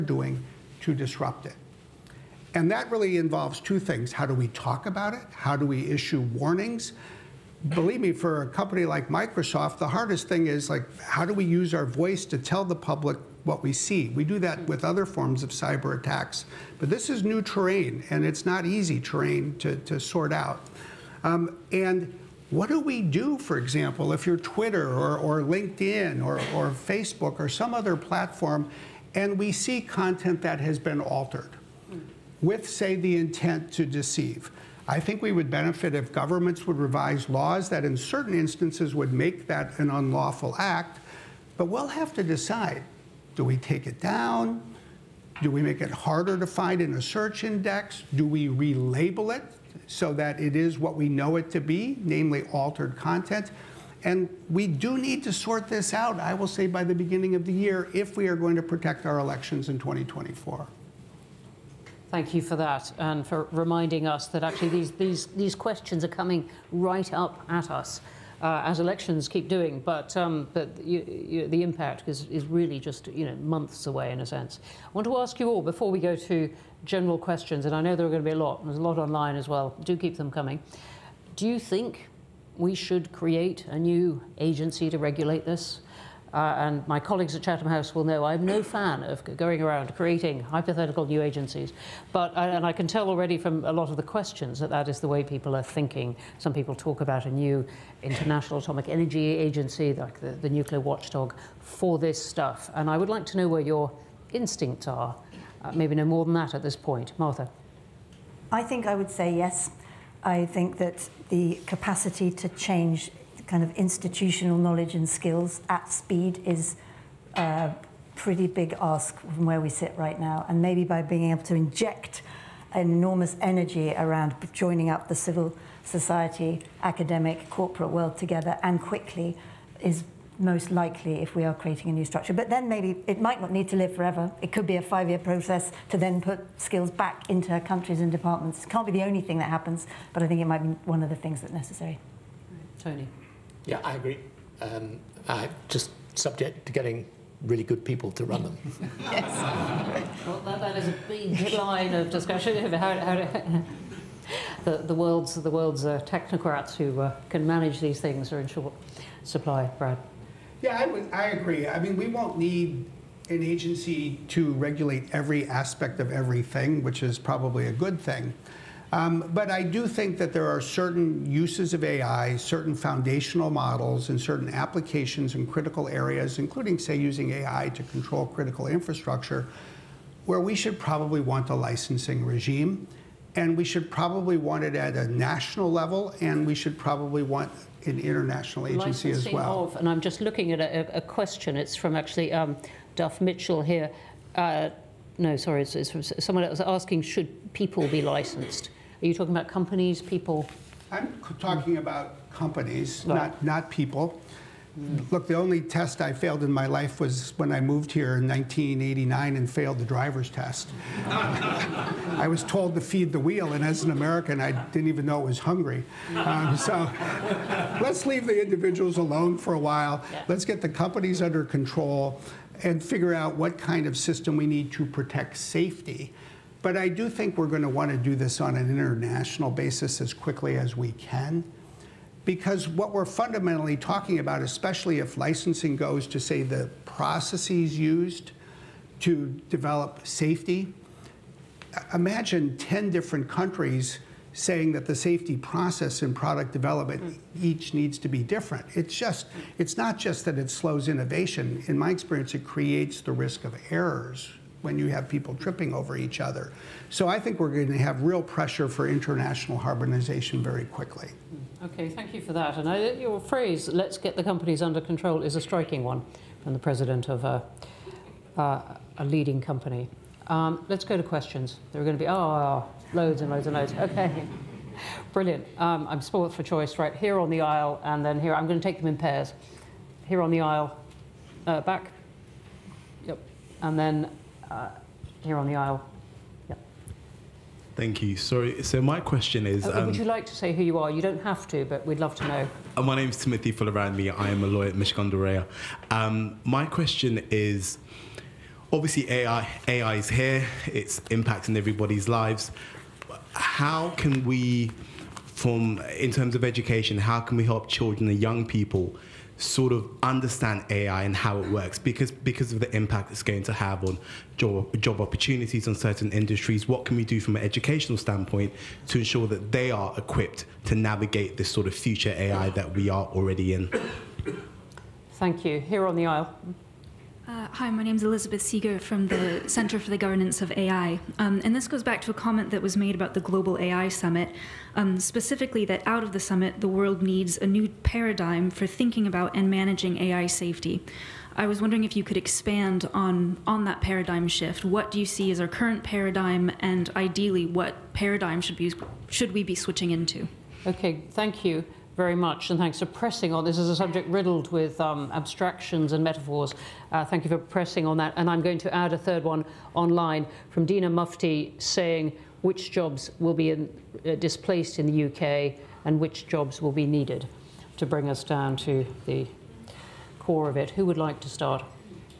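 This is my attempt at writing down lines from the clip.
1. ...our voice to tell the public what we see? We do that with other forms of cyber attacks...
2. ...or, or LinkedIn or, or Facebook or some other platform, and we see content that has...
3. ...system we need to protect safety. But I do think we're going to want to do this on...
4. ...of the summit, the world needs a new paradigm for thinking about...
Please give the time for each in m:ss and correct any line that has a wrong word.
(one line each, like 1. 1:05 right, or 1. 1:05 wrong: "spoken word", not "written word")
1. 0:11 right
2. 0:24 right
3. 3:43 right
4. 5:36 right.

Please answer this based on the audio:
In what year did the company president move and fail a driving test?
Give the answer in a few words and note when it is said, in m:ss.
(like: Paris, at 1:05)
1989, at 3:28.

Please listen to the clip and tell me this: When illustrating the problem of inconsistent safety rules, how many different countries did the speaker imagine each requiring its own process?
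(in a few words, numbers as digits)
10.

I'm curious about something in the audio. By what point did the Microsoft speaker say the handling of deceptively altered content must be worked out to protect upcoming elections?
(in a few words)
beginning of the year.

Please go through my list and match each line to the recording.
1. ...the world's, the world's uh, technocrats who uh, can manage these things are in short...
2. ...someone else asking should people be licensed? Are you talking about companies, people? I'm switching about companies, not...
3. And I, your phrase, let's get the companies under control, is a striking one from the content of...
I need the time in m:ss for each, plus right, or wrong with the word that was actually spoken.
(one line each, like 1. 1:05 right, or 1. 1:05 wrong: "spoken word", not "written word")
1. 2:34 right
2. 3:16 wrong: "talking", not "switching"
3. 4:22 wrong: "president", not "content".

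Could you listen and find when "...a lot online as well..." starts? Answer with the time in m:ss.
1:18.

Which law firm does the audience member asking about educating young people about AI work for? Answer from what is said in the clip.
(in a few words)
Mishcon de Reya.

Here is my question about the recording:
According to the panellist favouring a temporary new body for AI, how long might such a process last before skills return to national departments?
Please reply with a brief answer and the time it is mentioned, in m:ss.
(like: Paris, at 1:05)
five year, at 2:14.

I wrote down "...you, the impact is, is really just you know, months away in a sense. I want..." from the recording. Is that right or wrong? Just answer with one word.
right.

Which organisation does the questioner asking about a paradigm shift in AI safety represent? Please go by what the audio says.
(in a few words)
Center for the Governance of AI.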